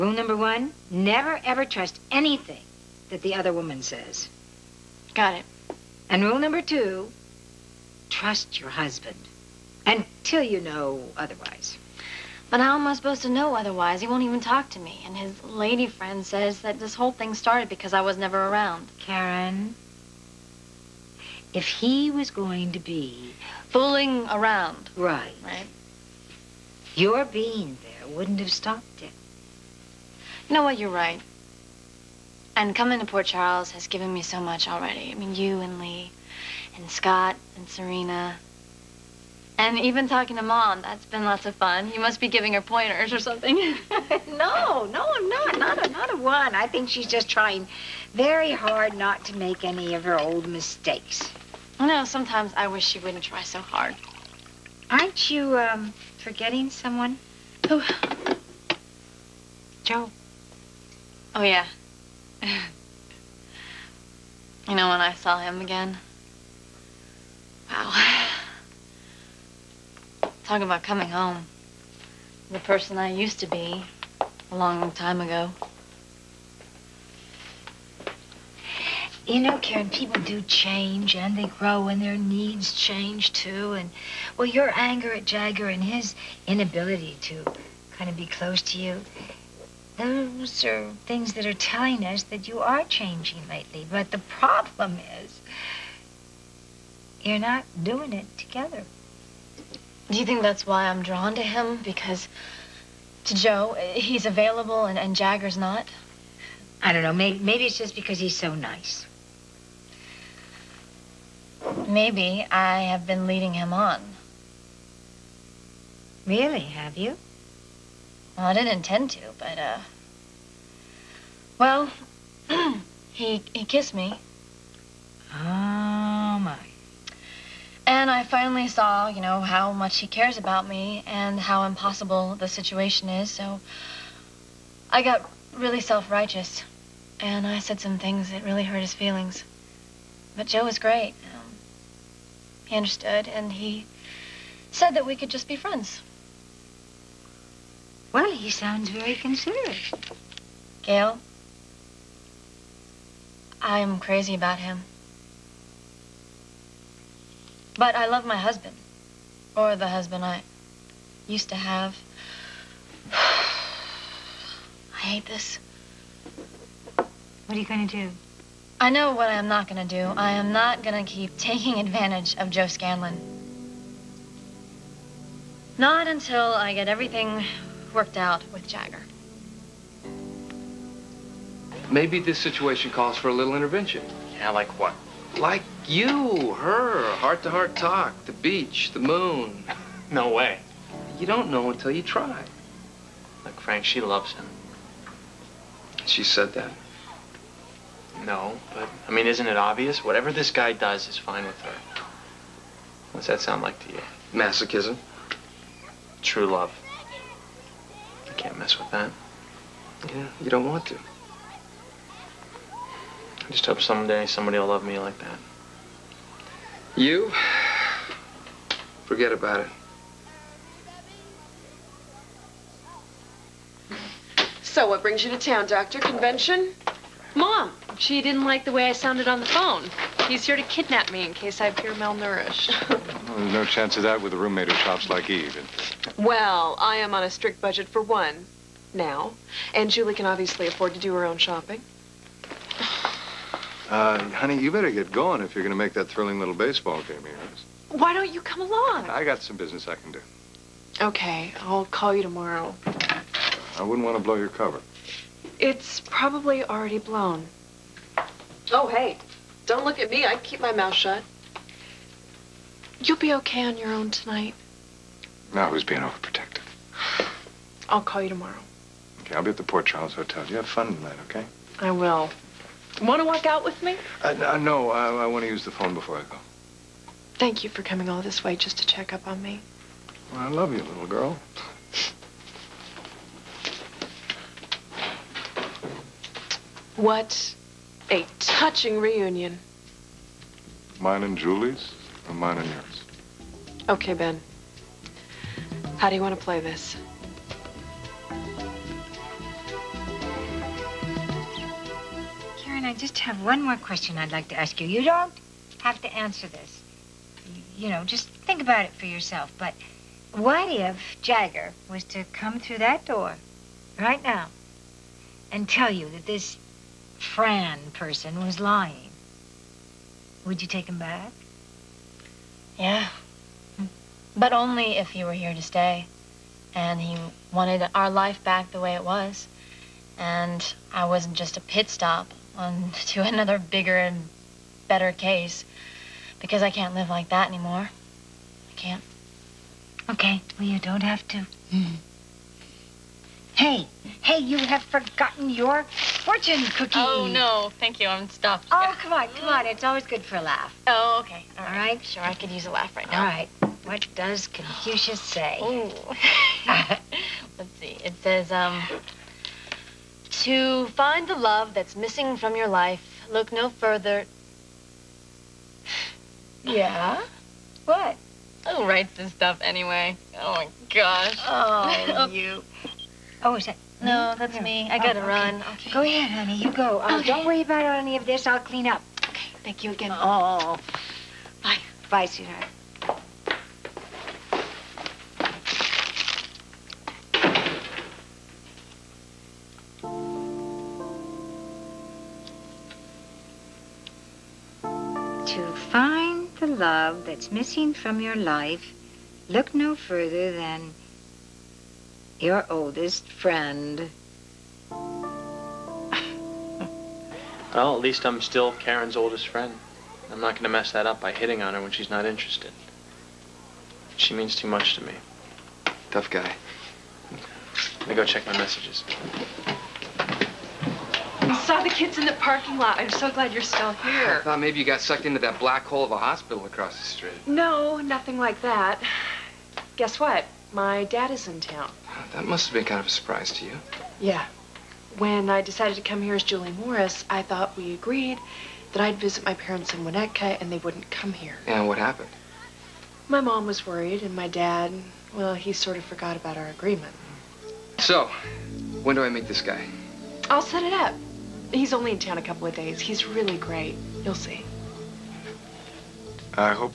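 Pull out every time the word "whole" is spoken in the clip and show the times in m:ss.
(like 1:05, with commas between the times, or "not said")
0:16.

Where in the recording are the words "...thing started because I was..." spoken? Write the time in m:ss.
0:17.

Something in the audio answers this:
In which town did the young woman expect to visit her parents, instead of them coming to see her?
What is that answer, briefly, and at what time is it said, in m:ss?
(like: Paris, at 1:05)
Winnetka, at 7:20.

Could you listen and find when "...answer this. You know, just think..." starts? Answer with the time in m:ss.
5:06.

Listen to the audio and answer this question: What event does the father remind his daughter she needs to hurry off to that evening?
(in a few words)
baseball game.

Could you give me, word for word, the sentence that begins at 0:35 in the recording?
I mean, you and Lee, and Scott, and Serena.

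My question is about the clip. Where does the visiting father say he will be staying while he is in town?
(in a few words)
Port Charles Hotel.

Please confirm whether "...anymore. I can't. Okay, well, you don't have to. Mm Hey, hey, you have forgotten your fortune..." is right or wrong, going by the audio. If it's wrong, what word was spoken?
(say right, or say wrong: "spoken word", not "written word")
right.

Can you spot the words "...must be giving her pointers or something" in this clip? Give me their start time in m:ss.
0:42.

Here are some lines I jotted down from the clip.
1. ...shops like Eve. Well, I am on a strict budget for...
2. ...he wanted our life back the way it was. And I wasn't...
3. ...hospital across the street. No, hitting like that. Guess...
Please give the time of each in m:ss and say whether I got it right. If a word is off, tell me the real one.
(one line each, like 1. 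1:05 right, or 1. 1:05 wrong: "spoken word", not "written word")
1. 3:54 right
2. 5:27 right
3. 7:06 wrong: "nothing", not "hitting".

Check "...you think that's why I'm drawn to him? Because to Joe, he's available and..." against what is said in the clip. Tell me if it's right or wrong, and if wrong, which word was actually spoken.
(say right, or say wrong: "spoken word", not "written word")
right.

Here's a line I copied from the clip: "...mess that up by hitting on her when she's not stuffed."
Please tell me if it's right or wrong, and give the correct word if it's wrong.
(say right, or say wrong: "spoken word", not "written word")
wrong: "interested", not "stuffed".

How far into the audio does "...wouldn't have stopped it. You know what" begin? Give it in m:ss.
0:28.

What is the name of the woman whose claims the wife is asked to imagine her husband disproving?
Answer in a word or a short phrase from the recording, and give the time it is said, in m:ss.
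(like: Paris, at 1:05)
Fran, at 5:17.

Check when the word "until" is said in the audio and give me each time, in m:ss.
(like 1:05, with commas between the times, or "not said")
0:09, 2:56, 3:11.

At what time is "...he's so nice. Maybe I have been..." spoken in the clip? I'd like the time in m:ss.
1:48.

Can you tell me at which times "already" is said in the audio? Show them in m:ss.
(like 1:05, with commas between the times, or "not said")
0:34, 4:16.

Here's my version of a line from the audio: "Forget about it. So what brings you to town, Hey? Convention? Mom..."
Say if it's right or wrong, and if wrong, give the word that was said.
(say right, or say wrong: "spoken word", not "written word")
wrong: "Doctor", not "Hey".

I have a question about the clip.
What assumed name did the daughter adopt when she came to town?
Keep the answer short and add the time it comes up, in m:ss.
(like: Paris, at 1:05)
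Julie Morris, at 7:16.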